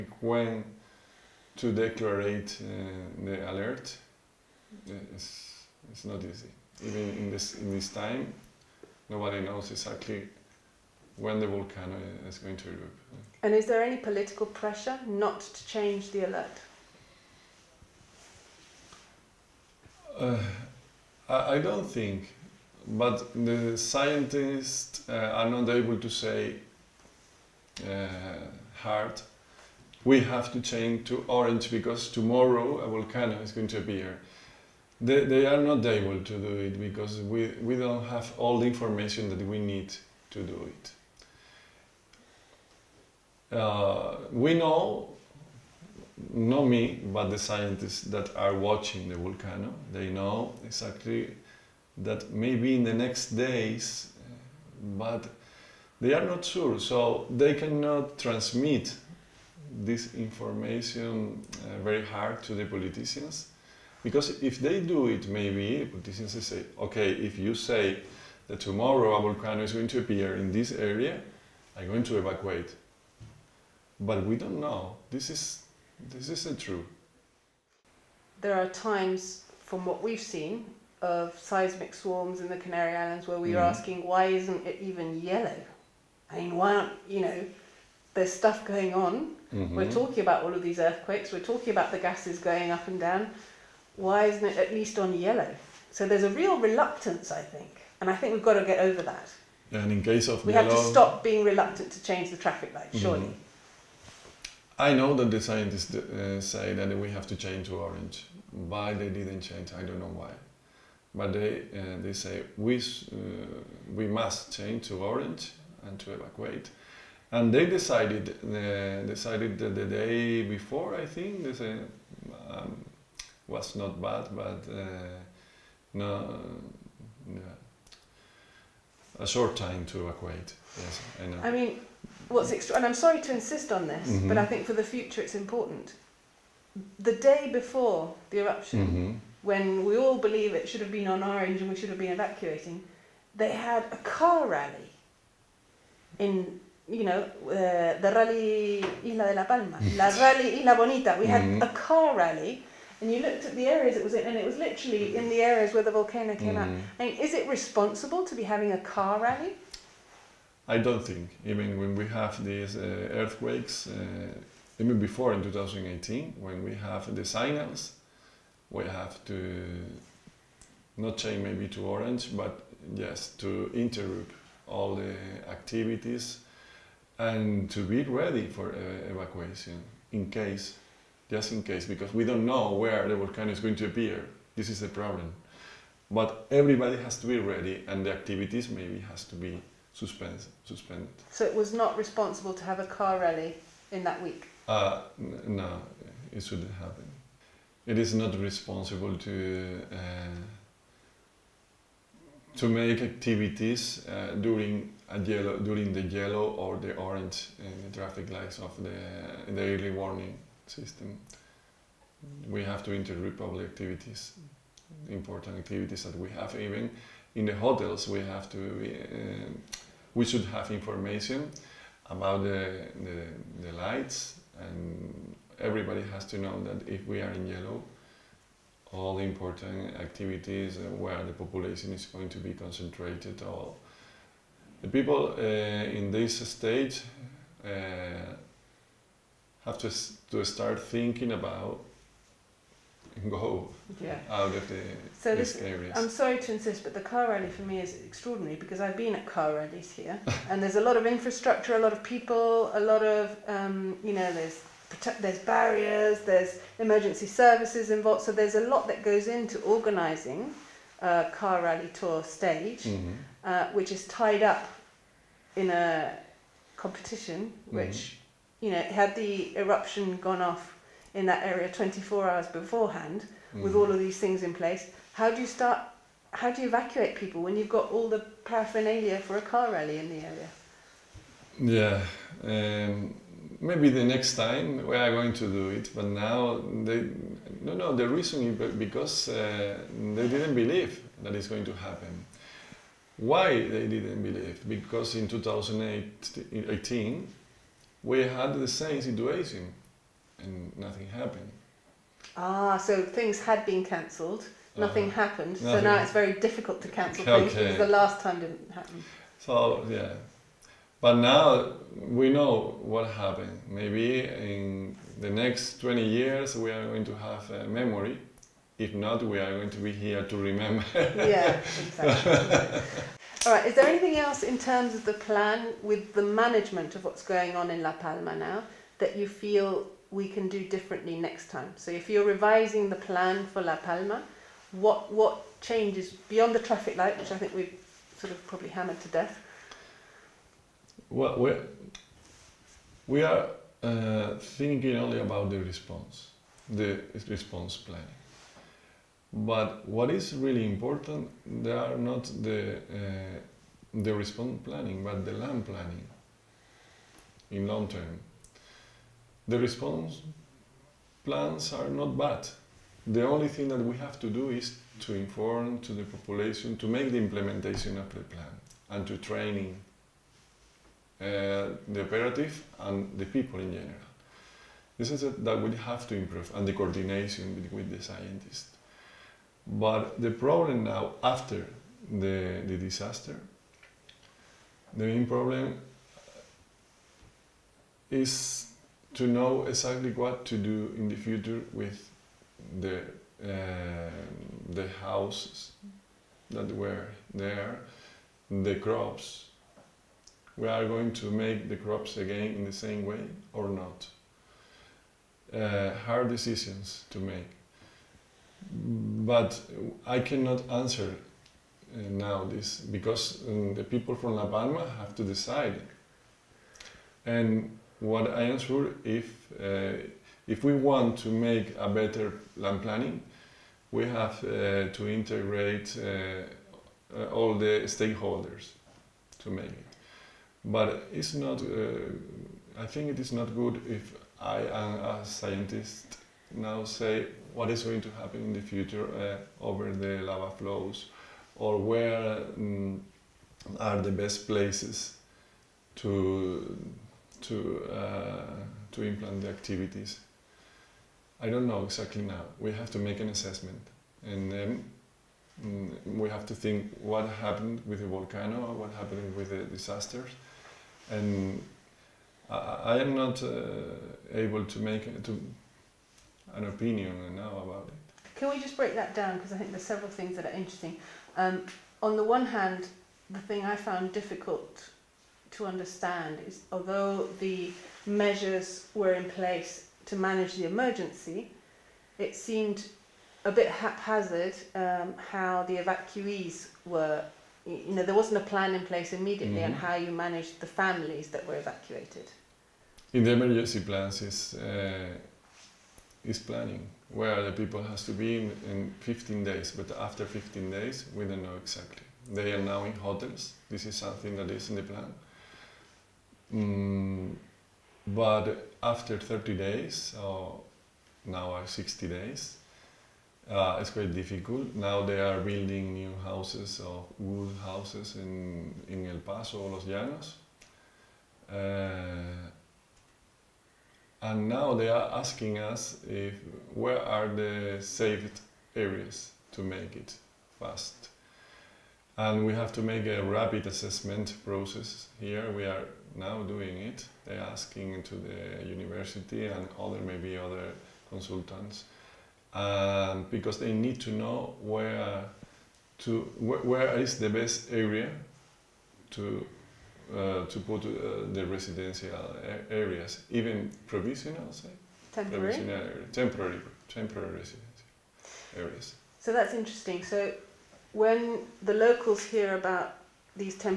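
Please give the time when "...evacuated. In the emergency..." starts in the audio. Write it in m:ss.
8:11.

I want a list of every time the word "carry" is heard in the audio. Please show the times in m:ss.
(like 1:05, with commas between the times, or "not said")
not said.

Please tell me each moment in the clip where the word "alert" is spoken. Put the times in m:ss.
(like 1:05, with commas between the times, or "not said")
0:03, 0:16.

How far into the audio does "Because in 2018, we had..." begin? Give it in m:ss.
4:54.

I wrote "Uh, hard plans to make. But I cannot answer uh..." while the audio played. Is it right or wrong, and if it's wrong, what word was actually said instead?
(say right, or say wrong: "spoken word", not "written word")
wrong: "decisions", not "plans".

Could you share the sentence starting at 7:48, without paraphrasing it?
Can we just break that down because I think there's several things that are interesting.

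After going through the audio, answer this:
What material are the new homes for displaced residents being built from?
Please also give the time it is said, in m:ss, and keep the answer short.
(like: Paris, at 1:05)
wood, at 8:37.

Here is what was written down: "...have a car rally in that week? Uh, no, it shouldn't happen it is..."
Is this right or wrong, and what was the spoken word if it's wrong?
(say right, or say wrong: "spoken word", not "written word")
right.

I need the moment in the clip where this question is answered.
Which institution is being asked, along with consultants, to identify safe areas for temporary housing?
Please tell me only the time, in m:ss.
8:58.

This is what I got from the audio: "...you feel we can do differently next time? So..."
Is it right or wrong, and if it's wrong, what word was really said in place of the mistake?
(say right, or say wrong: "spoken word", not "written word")
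right.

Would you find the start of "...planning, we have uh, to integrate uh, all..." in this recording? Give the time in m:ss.
7:02.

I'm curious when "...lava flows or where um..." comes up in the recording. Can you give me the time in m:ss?
7:20.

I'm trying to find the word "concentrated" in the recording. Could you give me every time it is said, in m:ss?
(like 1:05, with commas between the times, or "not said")
3:52.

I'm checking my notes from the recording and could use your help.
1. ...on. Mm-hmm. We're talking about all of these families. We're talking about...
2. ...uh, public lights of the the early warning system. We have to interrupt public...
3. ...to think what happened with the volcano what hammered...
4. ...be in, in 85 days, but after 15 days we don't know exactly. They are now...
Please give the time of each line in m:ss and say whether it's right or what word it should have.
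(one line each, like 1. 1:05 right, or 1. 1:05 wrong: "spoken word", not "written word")
1. 1:28 wrong: "earthquakes", not "families"
2. 3:27 wrong: "traffic", not "public"
3. 7:36 wrong: "happened", not "hammered"
4. 8:18 wrong: "15", not "85".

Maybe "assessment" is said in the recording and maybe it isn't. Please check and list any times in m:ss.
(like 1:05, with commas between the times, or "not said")
7:33, 8:53.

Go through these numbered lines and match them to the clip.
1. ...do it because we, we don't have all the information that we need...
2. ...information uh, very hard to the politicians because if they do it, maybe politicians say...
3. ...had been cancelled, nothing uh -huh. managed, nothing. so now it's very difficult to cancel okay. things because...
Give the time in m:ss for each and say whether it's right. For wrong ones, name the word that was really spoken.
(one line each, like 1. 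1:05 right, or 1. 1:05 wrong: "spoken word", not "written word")
1. 0:36 right
2. 1:00 right
3. 5:03 wrong: "happened", not "managed".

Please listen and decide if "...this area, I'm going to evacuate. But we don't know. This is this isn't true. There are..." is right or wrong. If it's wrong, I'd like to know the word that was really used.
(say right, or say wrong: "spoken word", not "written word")
right.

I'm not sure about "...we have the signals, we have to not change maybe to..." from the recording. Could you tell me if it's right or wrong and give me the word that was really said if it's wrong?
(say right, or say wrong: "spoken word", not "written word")
right.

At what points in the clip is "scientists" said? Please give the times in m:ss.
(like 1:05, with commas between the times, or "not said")
0:23, 0:47, 1:45, 6:18, 7:15.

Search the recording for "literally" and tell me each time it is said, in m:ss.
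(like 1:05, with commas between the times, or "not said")
2:34.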